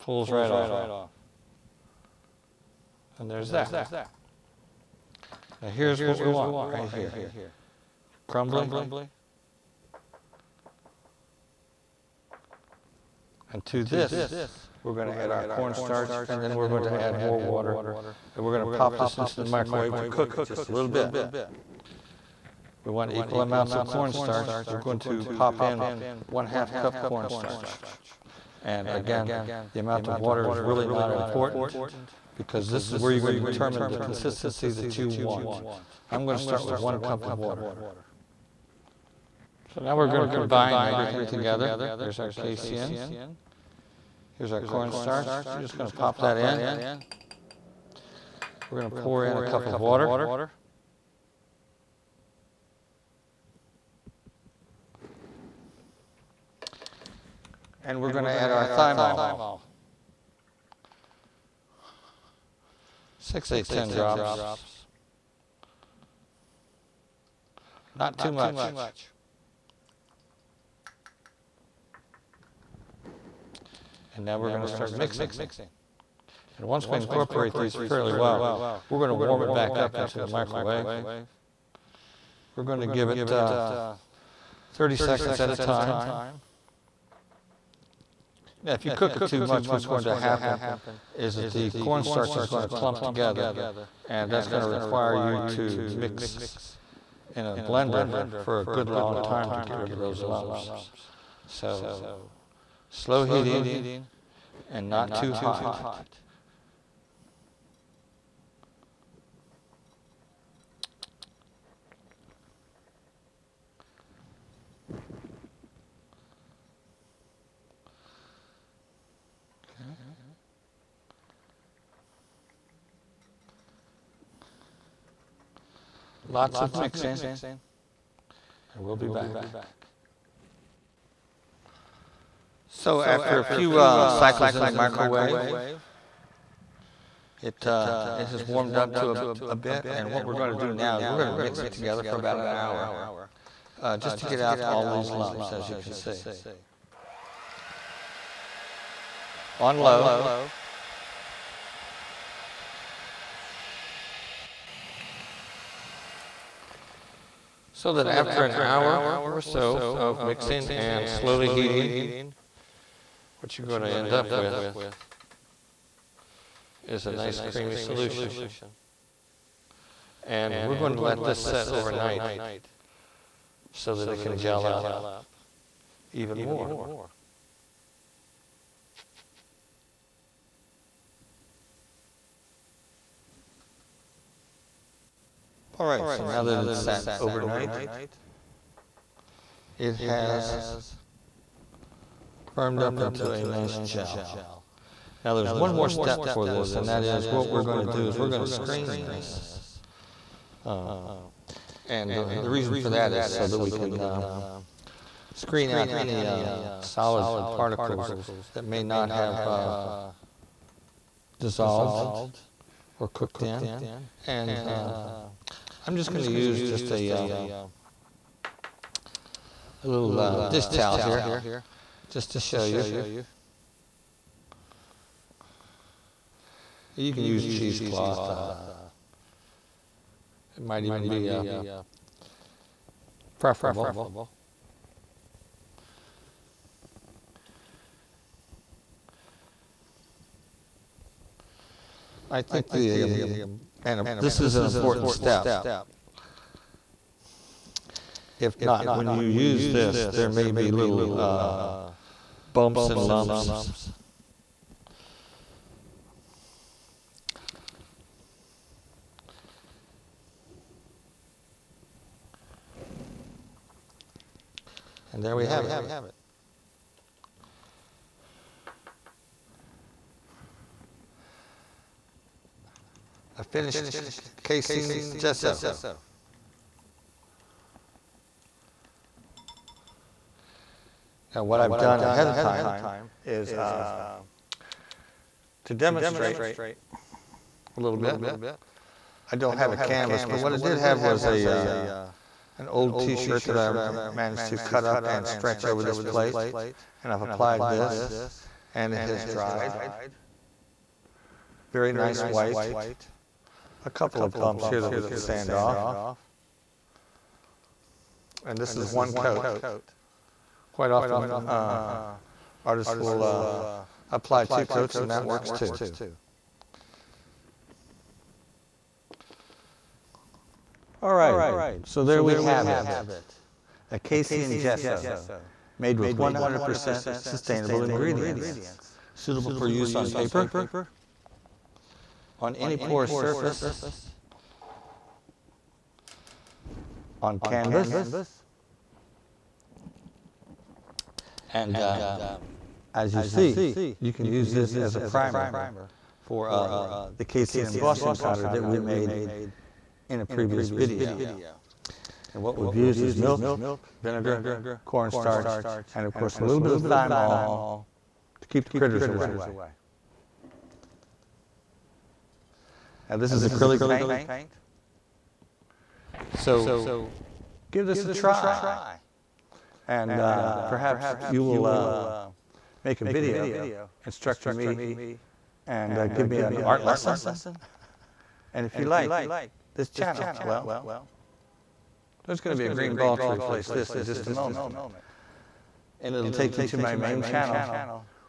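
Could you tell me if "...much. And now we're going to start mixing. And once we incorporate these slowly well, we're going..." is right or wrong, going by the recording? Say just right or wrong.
wrong.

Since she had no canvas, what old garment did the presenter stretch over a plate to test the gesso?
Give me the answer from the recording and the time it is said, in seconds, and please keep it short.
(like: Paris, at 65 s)
t-shirt, at 292 s.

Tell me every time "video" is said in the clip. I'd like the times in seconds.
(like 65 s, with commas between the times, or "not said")
350 s, 373 s.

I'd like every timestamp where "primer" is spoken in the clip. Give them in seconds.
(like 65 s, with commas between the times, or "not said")
345 s.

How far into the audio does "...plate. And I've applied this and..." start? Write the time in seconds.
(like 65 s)
296 s.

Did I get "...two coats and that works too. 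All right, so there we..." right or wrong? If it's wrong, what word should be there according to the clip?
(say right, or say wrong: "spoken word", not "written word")
right.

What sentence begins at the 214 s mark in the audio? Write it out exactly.
And uh, I'm just going to use just a, uh, a little uh, dish towel here just to show you.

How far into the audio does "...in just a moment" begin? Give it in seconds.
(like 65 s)
383 s.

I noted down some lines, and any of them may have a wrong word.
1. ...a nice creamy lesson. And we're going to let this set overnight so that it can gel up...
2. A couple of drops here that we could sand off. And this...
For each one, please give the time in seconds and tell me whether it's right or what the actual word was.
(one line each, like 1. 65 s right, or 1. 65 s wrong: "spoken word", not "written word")
1. 167 s wrong: "solution", not "lesson"
2. 303 s wrong: "bumps", not "drops".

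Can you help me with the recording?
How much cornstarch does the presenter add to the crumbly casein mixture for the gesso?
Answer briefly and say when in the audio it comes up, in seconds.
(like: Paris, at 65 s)
1/2 cup, at 26 s.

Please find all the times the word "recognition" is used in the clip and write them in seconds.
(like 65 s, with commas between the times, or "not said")
not said.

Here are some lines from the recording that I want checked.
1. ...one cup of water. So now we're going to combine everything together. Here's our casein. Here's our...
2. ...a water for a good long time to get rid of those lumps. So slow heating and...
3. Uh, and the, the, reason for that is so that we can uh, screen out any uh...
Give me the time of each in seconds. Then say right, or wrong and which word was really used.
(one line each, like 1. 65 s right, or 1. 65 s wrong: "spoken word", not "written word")
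1. 36 s right
2. 97 s wrong: "blender", not "water"
3. 200 s right.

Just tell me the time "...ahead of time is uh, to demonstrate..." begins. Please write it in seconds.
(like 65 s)
282 s.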